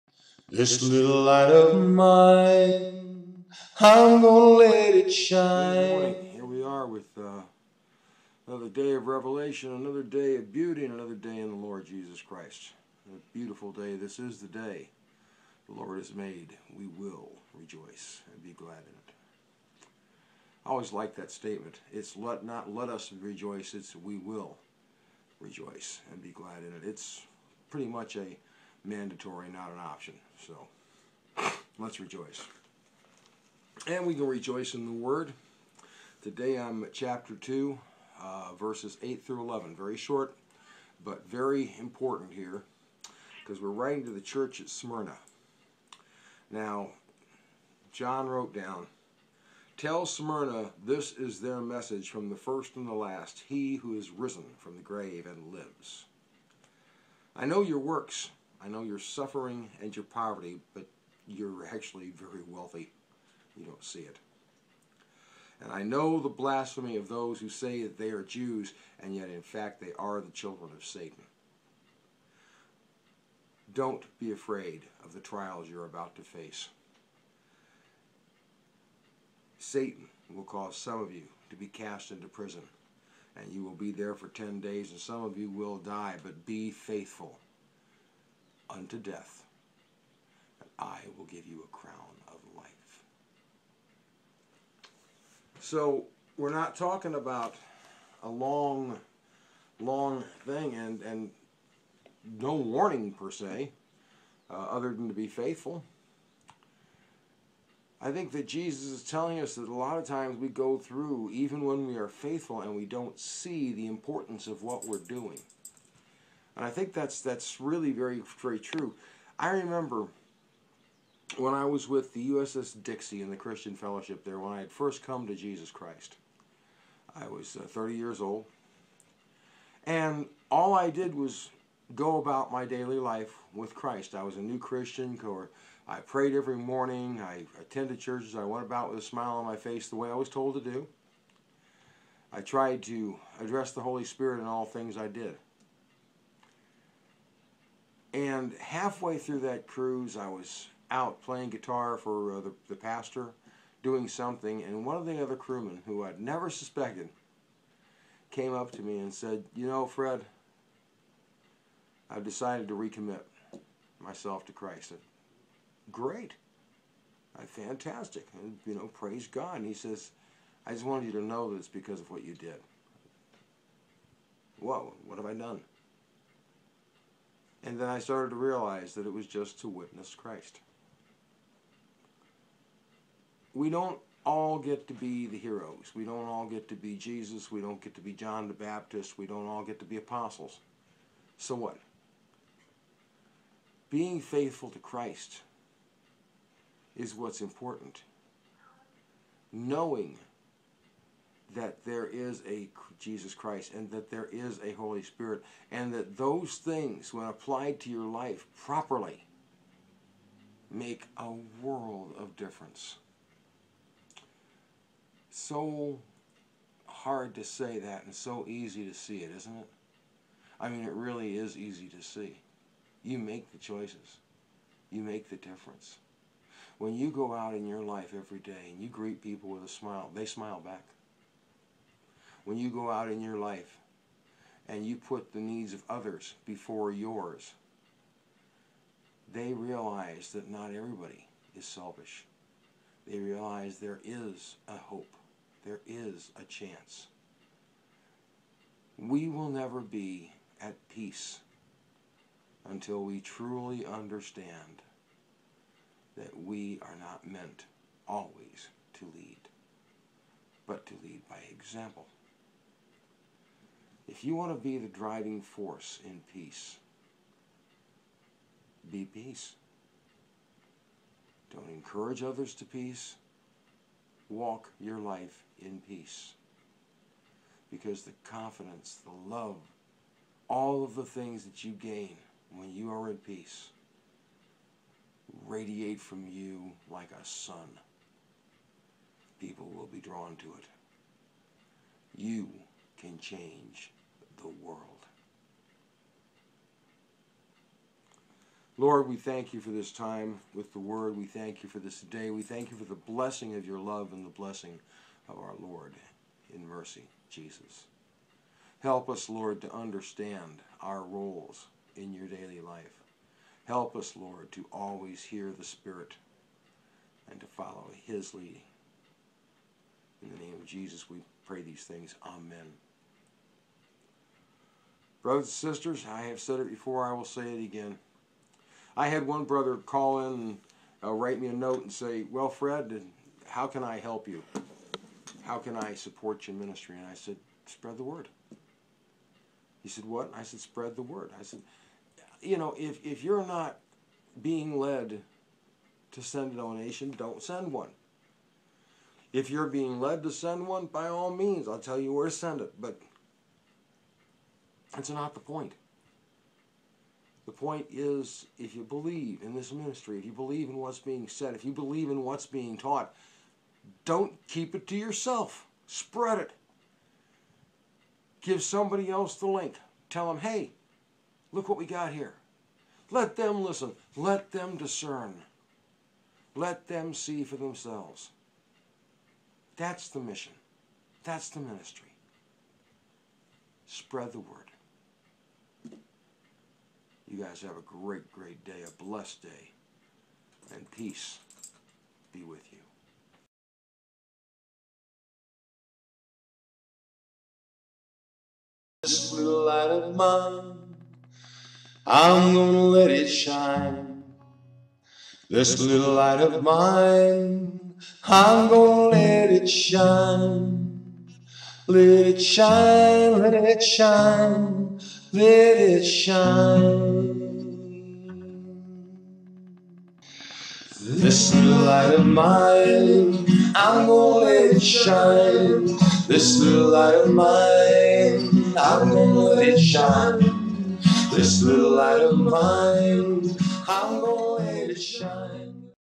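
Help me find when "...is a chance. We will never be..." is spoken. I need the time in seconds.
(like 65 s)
245 s.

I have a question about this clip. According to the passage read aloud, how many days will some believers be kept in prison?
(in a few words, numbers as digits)
10.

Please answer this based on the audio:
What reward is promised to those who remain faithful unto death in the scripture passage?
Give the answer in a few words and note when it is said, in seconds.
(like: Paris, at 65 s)
A crown of life, at 91 s.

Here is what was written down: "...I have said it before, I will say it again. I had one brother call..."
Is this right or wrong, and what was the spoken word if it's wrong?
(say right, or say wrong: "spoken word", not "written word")
right.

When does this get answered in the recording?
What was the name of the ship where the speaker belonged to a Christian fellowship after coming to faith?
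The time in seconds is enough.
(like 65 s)
122 s.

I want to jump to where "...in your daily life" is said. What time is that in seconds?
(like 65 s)
311 s.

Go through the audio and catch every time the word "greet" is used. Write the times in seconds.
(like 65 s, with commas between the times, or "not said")
228 s.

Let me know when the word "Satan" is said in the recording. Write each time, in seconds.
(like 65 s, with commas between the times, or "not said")
70 s, 79 s.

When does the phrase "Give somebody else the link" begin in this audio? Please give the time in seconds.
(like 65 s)
368 s.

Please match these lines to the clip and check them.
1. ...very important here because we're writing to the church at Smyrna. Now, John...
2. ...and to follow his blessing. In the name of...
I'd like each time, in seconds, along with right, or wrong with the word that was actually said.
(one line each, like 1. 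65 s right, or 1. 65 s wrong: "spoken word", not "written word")
1. 41 s right
2. 317 s wrong: "leading", not "blessing".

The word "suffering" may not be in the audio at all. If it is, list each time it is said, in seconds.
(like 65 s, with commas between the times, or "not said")
58 s.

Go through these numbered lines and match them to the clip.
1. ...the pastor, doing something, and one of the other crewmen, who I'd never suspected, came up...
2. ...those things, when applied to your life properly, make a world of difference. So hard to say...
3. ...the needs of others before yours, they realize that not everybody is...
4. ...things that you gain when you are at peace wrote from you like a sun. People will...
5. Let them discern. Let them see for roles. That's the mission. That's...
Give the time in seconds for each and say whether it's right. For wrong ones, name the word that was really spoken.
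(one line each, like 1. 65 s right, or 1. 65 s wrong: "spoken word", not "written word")
1. 152 s right
2. 206 s right
3. 235 s right
4. 281 s wrong: "radiate", not "wrote"
5. 374 s wrong: "themselves", not "roles".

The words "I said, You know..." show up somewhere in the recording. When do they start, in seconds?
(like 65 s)
341 s.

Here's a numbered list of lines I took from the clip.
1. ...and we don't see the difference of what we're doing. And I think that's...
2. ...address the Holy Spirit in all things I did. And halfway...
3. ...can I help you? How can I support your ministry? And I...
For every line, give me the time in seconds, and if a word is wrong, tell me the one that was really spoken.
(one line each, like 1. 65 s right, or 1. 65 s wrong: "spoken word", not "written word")
1. 112 s wrong: "importance", not "difference"
2. 143 s right
3. 333 s right.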